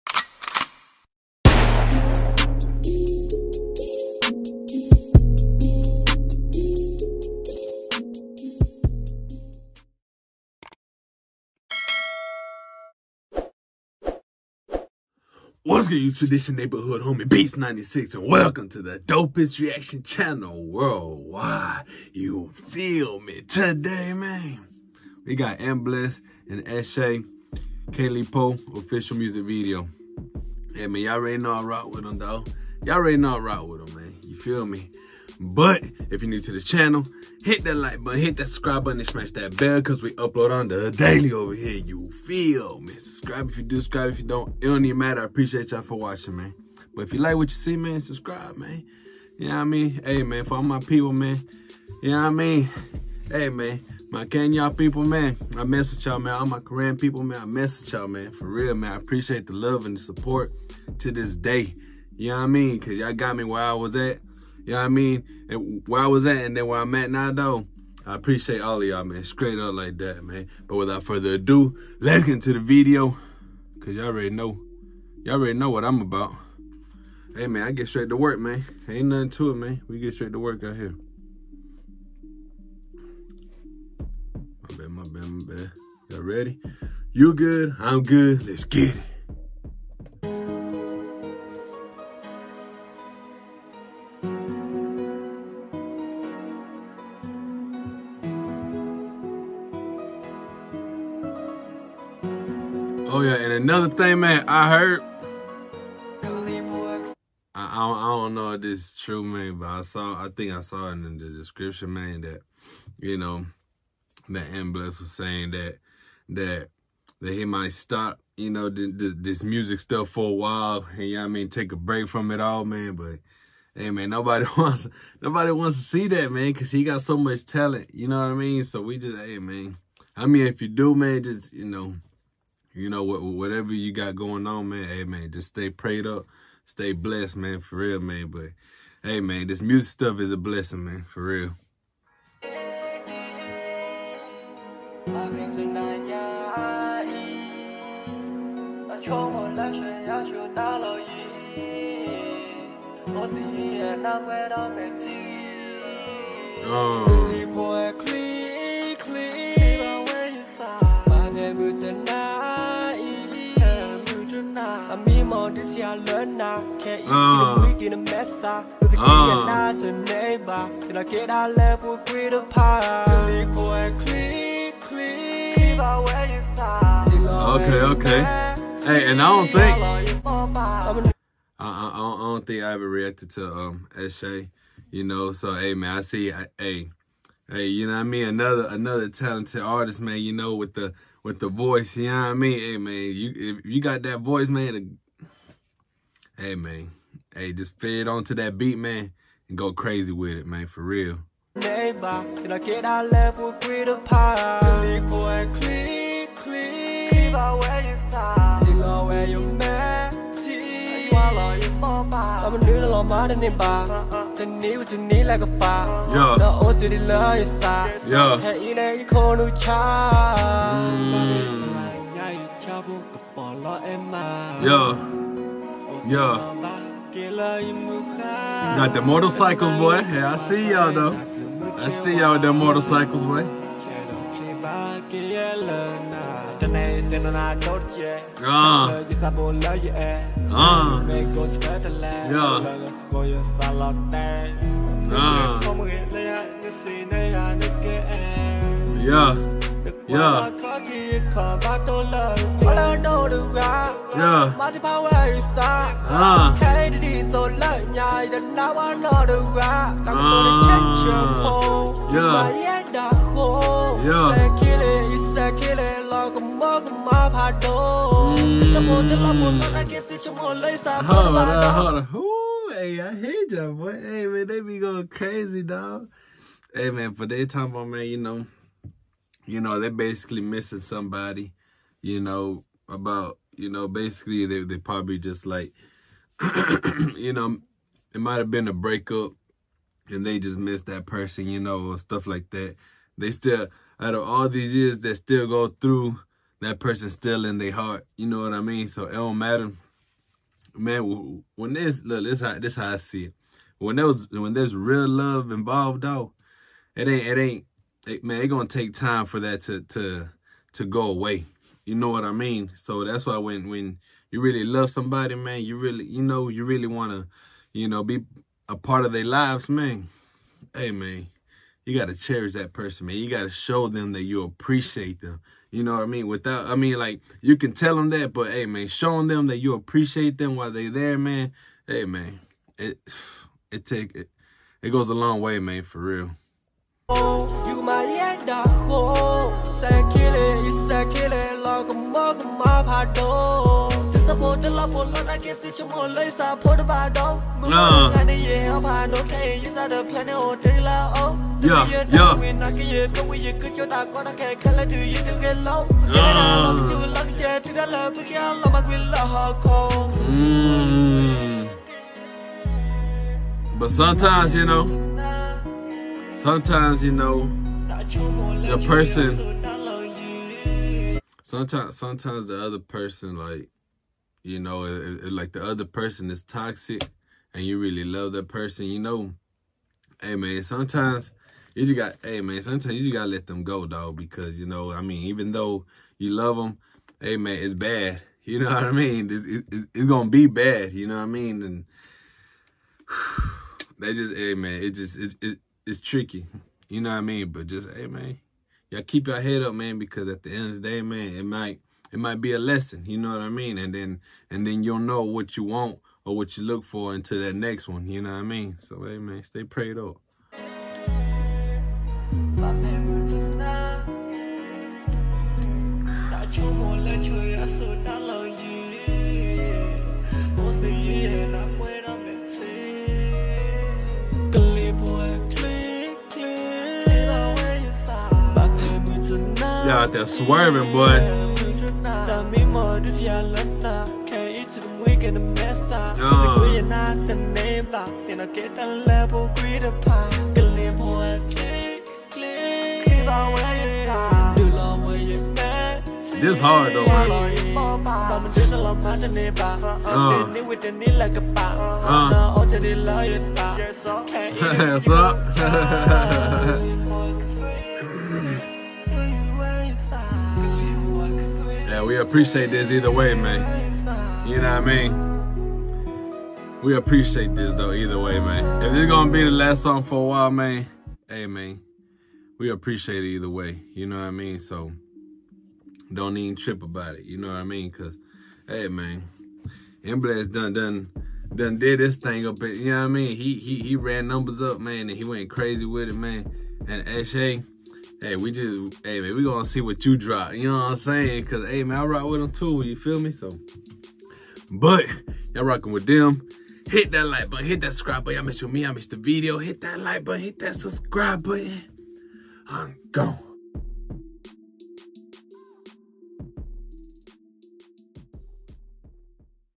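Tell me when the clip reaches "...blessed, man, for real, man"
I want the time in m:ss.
2:16.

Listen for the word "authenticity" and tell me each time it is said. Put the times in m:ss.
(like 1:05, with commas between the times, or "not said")
not said.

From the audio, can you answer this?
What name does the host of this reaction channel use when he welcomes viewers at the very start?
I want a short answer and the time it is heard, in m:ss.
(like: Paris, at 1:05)
Beatz 96, at 0:17.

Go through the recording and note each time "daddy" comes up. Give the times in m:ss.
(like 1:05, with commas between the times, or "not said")
not said.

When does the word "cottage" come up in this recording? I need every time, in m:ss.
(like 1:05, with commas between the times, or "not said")
not said.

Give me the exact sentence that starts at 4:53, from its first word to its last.
They still, out of all these years they still go through, that person still in their heart.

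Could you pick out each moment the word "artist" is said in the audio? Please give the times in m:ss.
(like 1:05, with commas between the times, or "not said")
3:09.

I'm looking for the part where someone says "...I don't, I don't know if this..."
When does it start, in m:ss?
1:47.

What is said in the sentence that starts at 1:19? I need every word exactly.
We get straight to work out here.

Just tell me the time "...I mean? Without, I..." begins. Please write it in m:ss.
5:26.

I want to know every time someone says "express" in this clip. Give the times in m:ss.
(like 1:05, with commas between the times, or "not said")
not said.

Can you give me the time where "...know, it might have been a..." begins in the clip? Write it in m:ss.
4:47.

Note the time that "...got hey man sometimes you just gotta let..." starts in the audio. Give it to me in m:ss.
6:21.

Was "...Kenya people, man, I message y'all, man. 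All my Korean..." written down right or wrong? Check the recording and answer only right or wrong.
right.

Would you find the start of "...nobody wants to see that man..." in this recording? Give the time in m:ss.
2:05.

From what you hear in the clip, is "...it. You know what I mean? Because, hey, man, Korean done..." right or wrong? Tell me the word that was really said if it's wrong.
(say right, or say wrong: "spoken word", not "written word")
wrong: "Bless", not "Korean".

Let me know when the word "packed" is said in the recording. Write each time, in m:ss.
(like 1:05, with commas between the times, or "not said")
not said.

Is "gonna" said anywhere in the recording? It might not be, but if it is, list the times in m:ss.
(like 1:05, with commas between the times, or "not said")
5:08, 6:30, 8:09.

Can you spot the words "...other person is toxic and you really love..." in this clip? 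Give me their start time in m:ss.
6:15.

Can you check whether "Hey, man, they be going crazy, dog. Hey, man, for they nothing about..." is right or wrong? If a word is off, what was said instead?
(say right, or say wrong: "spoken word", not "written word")
wrong: "talking", not "nothing".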